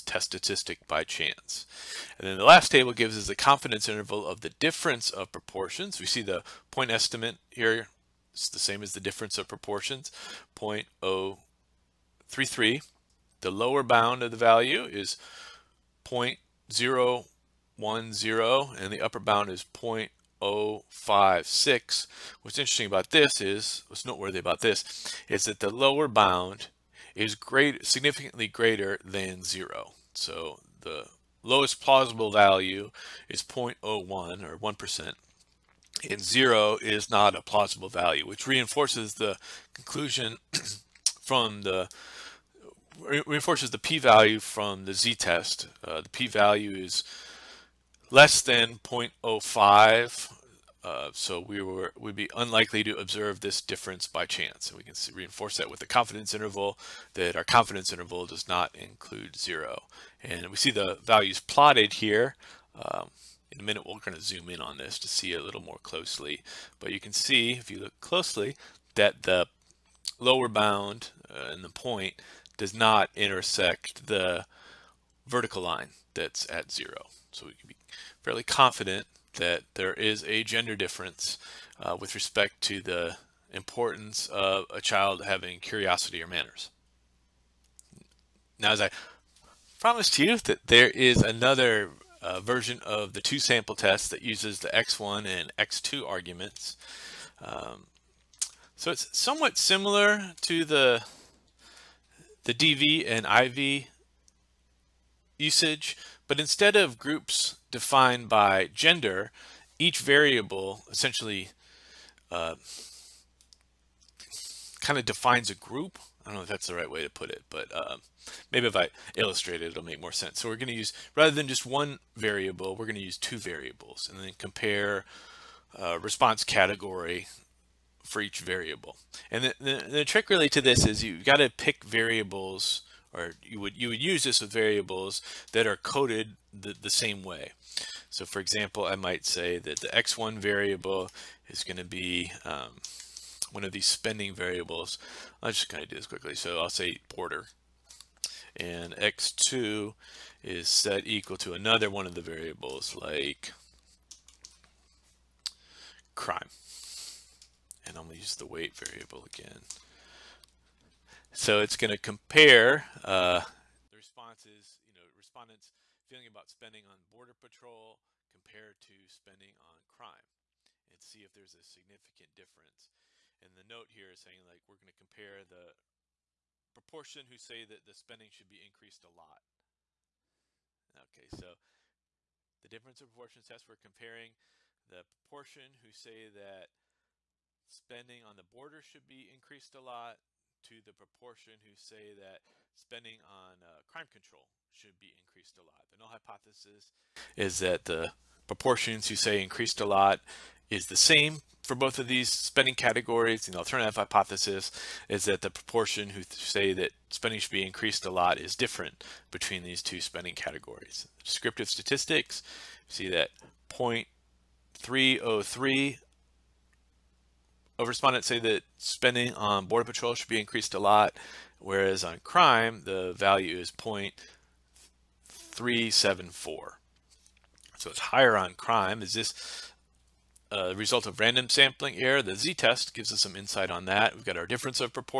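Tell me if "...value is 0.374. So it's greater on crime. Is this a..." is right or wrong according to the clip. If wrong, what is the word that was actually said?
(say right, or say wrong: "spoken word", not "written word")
wrong: "higher", not "greater".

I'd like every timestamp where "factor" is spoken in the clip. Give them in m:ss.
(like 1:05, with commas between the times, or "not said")
not said.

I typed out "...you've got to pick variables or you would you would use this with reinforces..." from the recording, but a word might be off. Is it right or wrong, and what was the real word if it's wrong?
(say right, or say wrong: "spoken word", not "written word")
wrong: "variables", not "reinforces".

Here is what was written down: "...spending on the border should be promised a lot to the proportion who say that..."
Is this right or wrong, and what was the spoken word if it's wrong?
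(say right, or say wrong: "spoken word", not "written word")
wrong: "increased", not "promised".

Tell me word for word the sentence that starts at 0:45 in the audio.
Uh, the p-value is less than 0.05 uh, so we were would be unlikely to observe this difference by chance.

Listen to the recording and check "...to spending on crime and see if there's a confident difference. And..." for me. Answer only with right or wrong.
wrong.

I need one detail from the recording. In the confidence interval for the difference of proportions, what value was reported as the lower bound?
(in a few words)
0.010.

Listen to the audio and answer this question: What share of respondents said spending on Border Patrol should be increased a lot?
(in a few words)
0.303.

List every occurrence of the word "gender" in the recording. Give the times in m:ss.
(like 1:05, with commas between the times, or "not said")
1:20, 1:48.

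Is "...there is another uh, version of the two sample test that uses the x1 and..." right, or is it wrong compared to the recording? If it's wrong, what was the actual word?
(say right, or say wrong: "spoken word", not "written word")
right.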